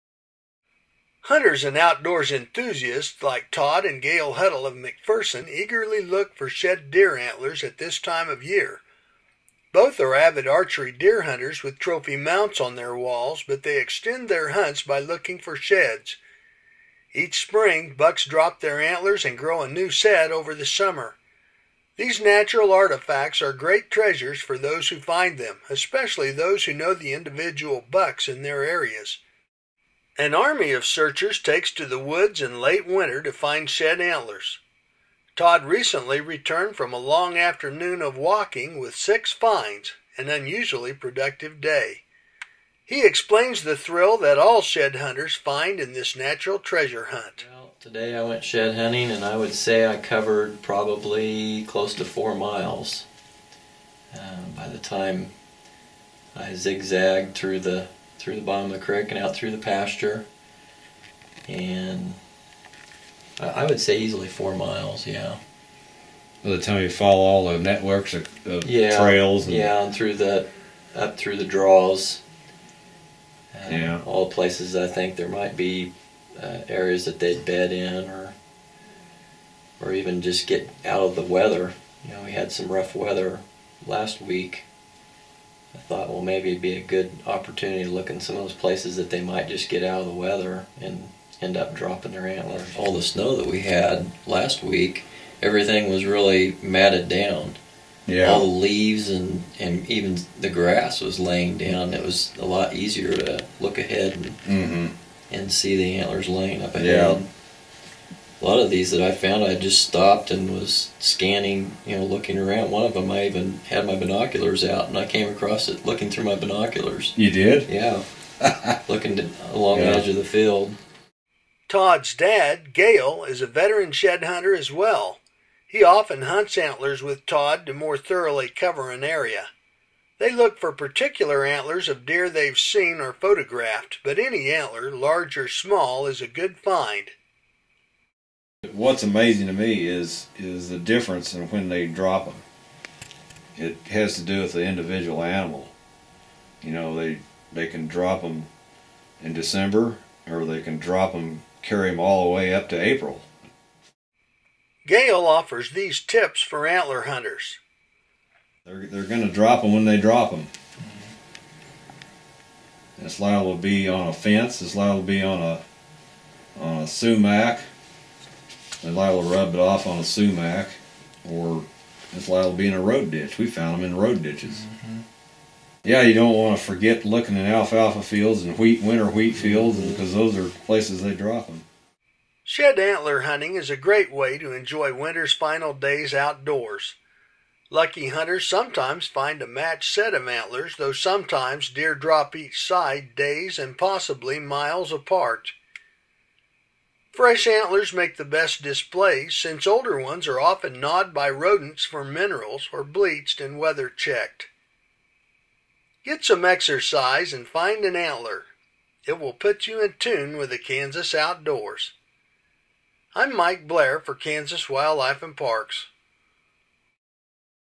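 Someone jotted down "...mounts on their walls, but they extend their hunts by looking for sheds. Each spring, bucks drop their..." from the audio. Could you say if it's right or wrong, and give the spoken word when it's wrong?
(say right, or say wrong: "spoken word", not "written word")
right.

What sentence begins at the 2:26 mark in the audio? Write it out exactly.
You know, they they can drop them in December, or they can drop them, carry them all the way up to April.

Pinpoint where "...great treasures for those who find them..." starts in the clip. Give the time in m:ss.
0:23.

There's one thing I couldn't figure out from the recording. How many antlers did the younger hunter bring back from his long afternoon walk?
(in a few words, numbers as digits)
6.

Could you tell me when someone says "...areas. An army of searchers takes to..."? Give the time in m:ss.
0:28.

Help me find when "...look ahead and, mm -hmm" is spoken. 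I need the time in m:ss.
1:43.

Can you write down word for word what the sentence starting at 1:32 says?
All the snow that we had last week, everything was really matted down.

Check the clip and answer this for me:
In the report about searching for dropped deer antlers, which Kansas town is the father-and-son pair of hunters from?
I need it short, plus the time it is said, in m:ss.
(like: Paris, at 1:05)
McPherson, at 0:04.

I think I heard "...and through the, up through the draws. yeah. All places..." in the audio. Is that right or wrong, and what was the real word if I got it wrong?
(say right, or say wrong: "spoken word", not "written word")
right.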